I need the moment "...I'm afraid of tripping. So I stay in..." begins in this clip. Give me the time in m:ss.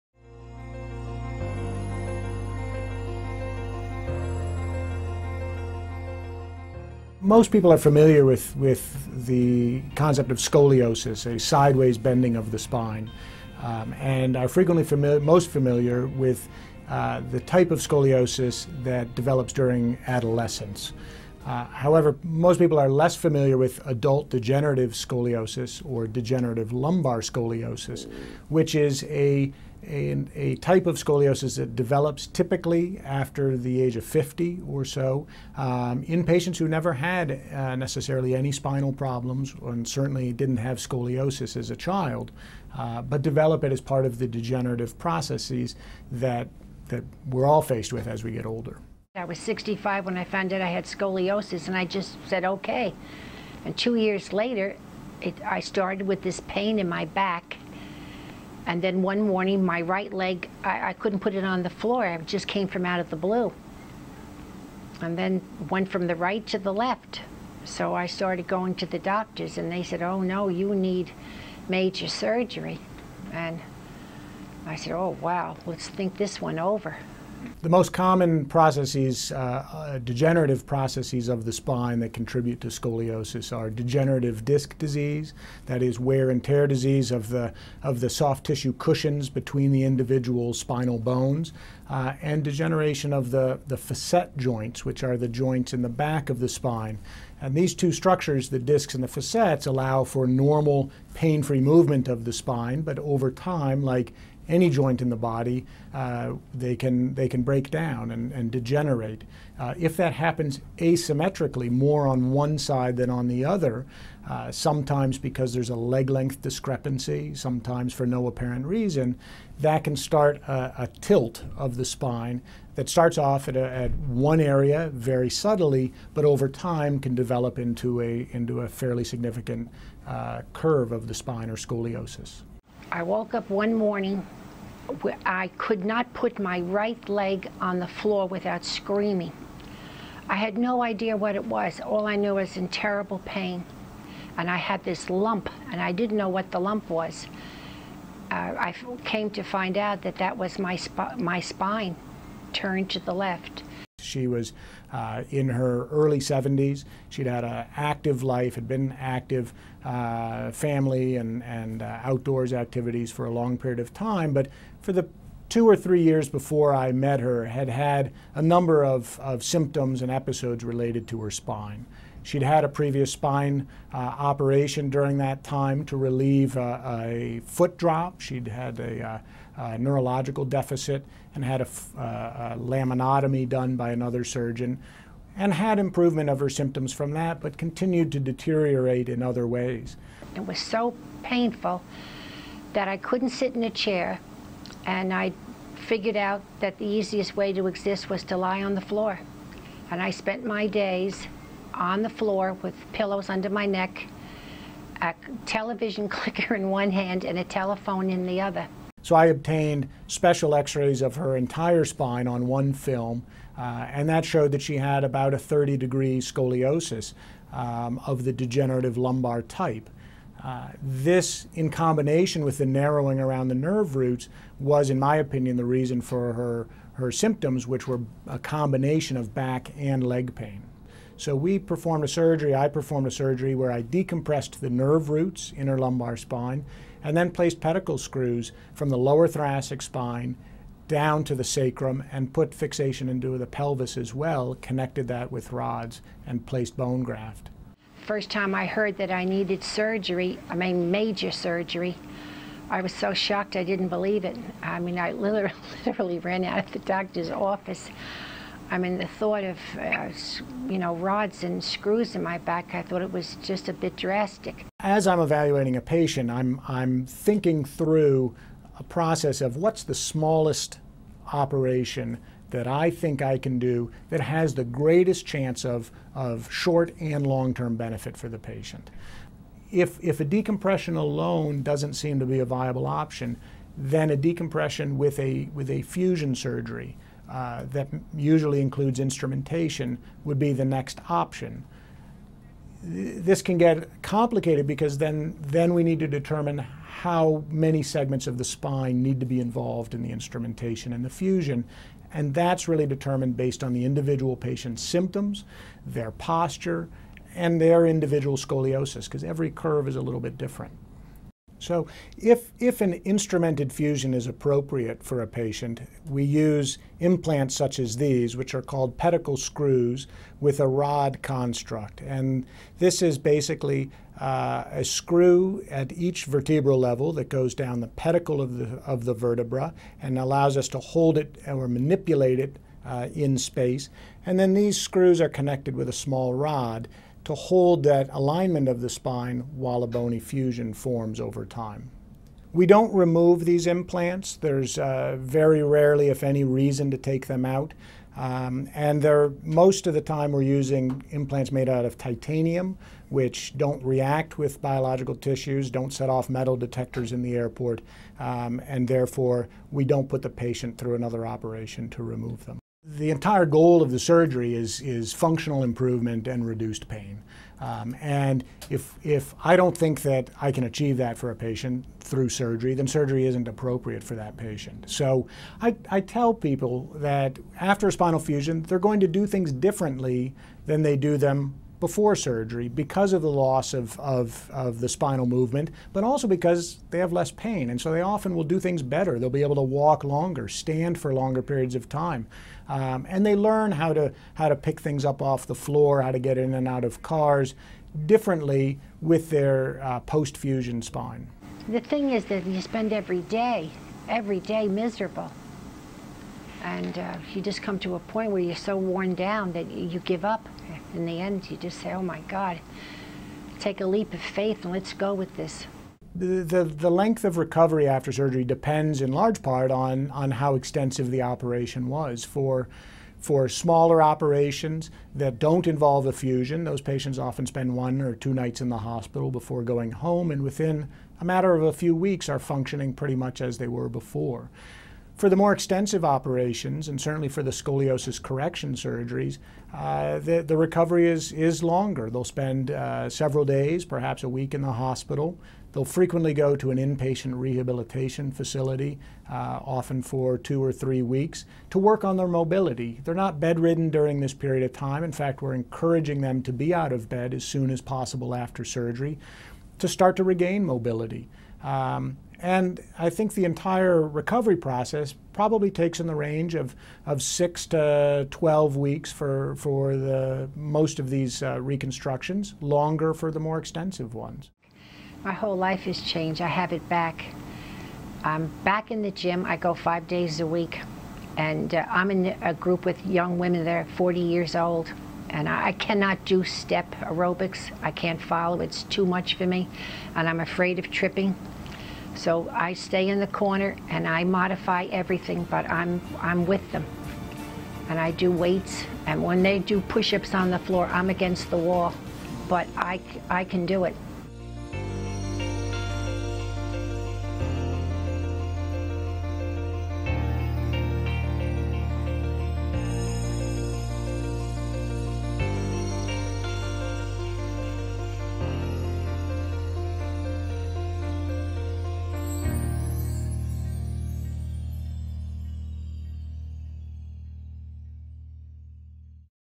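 8:10.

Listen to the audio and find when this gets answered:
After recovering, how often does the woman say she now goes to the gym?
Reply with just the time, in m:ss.
7:59.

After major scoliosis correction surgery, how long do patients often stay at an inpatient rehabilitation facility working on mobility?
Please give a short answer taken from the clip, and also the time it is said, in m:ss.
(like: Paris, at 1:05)
2 or 3 weeks, at 7:30.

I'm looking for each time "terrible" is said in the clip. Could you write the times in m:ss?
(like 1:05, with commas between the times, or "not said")
2:22.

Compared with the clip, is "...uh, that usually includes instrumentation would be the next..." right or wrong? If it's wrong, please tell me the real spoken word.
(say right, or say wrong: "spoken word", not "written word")
right.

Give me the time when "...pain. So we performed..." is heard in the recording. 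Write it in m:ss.
3:50.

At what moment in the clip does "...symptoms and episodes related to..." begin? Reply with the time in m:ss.
2:49.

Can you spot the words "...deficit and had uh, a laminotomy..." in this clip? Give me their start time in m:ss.
3:00.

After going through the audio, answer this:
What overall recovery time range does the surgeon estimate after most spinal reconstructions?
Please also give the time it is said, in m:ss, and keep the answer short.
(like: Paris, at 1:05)
6 to 12 weeks, at 7:47.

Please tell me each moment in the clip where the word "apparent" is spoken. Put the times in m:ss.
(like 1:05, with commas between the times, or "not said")
1:58.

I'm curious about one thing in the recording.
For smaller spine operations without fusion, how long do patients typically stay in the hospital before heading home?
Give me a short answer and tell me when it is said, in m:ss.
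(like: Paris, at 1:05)
1 or 2 nights, at 7:07.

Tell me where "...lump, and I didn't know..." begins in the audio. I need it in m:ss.
2:25.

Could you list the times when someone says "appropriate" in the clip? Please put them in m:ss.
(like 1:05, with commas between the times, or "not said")
5:14, 6:13.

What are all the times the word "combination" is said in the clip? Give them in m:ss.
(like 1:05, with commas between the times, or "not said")
3:41, 3:48.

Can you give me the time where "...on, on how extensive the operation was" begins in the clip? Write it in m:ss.
6:59.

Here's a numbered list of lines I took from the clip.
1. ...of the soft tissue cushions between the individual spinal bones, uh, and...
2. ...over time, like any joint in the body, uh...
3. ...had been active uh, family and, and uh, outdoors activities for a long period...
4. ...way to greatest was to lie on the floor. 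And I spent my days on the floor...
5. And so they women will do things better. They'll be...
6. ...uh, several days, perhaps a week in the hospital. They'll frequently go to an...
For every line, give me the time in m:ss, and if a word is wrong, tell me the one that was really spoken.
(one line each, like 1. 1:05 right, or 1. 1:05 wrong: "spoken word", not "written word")
1. 1:27 right
2. 1:42 right
3. 2:38 right
4. 3:17 wrong: "exist", not "greatest"
5. 6:27 wrong: "often", not "women"
6. 7:22 right.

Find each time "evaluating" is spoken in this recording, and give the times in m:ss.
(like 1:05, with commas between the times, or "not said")
4:25.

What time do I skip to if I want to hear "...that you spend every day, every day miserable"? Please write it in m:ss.
6:42.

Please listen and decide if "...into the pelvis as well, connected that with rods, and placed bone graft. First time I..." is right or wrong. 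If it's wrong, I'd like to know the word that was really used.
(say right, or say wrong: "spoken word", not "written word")
right.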